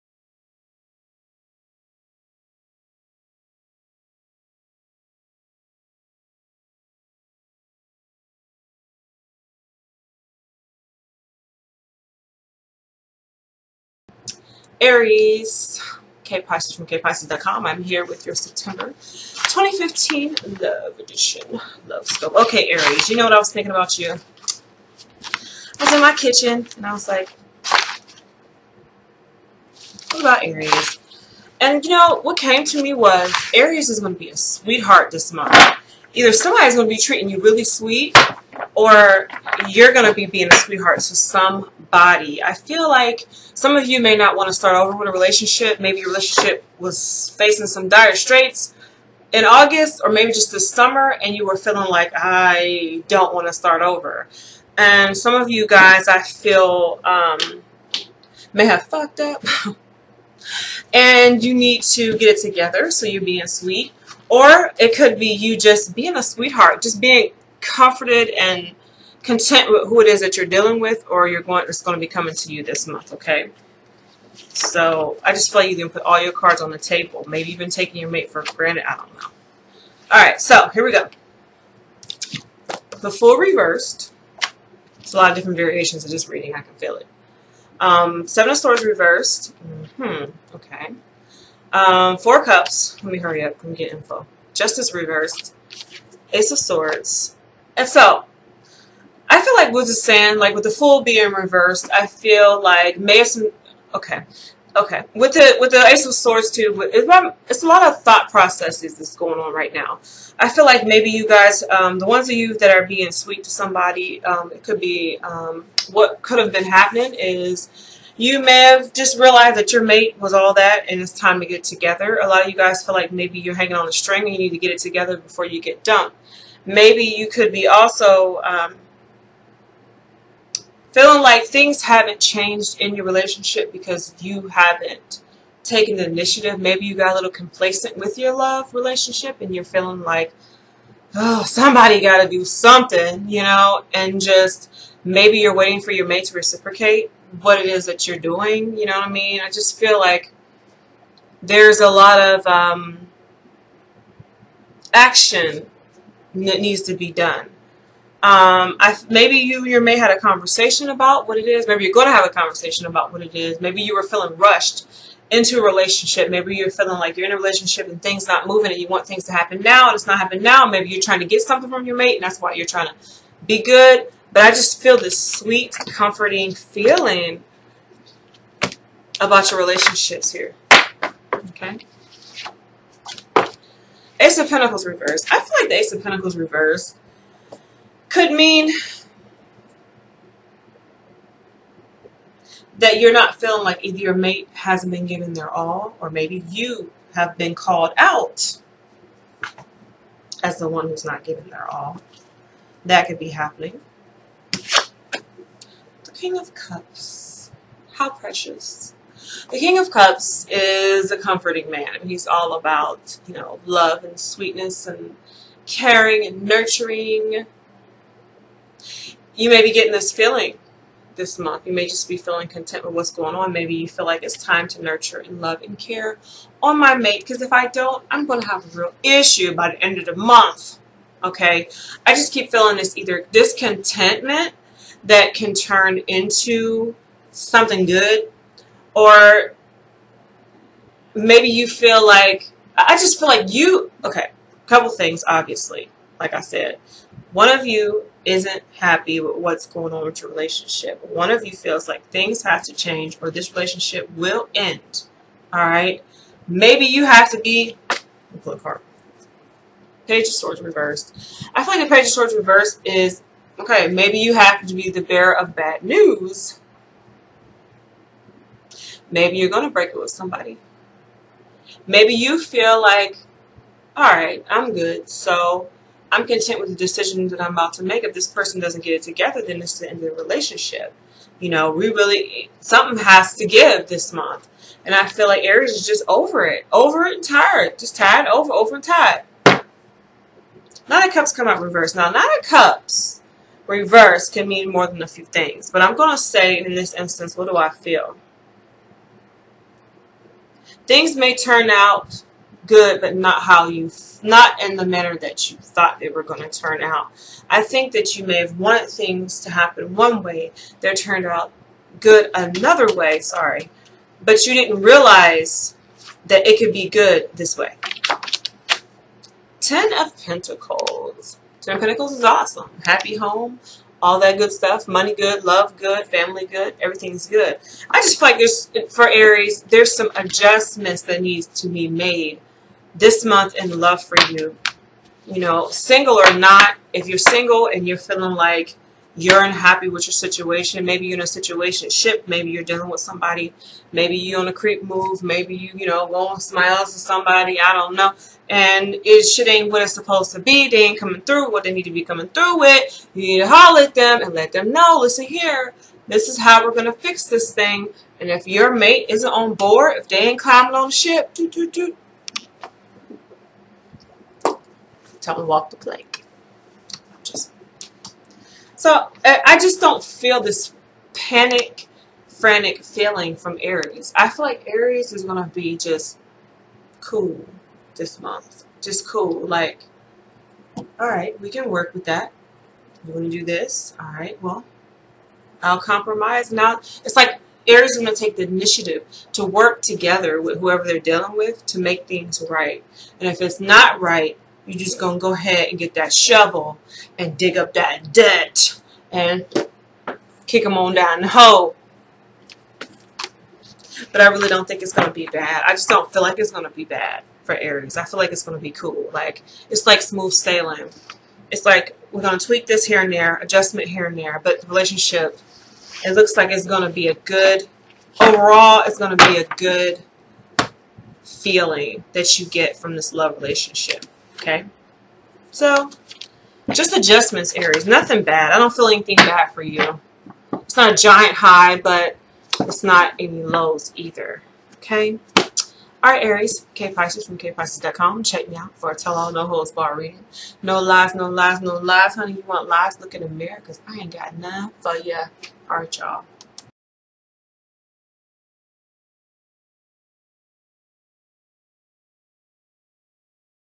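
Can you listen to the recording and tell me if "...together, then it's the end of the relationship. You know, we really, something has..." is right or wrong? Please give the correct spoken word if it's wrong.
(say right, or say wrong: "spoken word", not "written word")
right.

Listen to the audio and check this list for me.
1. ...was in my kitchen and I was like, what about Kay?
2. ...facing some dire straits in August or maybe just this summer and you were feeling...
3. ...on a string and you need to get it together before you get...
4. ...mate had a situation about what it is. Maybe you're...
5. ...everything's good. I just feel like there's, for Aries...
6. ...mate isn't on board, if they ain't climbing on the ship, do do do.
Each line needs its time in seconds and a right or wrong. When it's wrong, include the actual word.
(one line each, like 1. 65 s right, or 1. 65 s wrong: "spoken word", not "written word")
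1. 25 s wrong: "Aries", not "Kay"
2. 47 s right
3. 123 s right
4. 159 s wrong: "conversation", not "situation"
5. 326 s right
6. 358 s right.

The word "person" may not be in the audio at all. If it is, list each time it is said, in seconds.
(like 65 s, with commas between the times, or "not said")
278 s.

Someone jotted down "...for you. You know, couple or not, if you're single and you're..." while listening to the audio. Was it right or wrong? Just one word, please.
wrong.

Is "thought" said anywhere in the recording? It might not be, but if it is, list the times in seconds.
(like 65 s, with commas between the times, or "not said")
108 s, 305 s.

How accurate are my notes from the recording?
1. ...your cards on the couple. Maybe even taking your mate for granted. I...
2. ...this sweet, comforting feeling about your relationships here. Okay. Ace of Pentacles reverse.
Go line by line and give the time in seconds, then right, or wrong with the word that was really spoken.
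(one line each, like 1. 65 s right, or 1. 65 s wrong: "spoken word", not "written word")
1. 76 s wrong: "table", not "couple"
2. 174 s right.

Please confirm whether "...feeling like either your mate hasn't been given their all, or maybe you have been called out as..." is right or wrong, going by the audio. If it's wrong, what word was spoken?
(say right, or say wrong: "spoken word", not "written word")
right.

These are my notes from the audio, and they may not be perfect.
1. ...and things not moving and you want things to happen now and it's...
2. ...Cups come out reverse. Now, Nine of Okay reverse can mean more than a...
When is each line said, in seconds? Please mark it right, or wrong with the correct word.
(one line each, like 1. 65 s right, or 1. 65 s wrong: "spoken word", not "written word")
1. 167 s right
2. 291 s wrong: "Cups", not "Okay".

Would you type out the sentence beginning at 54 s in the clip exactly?
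And some of you guys, I feel, um, may have fucked up.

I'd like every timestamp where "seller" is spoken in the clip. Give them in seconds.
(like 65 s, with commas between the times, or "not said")
not said.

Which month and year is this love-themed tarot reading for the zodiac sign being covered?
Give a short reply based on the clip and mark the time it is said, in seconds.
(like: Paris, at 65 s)
September 2015, at 18 s.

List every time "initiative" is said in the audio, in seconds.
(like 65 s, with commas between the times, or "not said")
136 s, 388 s.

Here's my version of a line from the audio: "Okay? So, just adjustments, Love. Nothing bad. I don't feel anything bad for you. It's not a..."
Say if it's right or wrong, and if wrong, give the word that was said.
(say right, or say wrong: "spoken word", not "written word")
wrong: "Aries", not "Love".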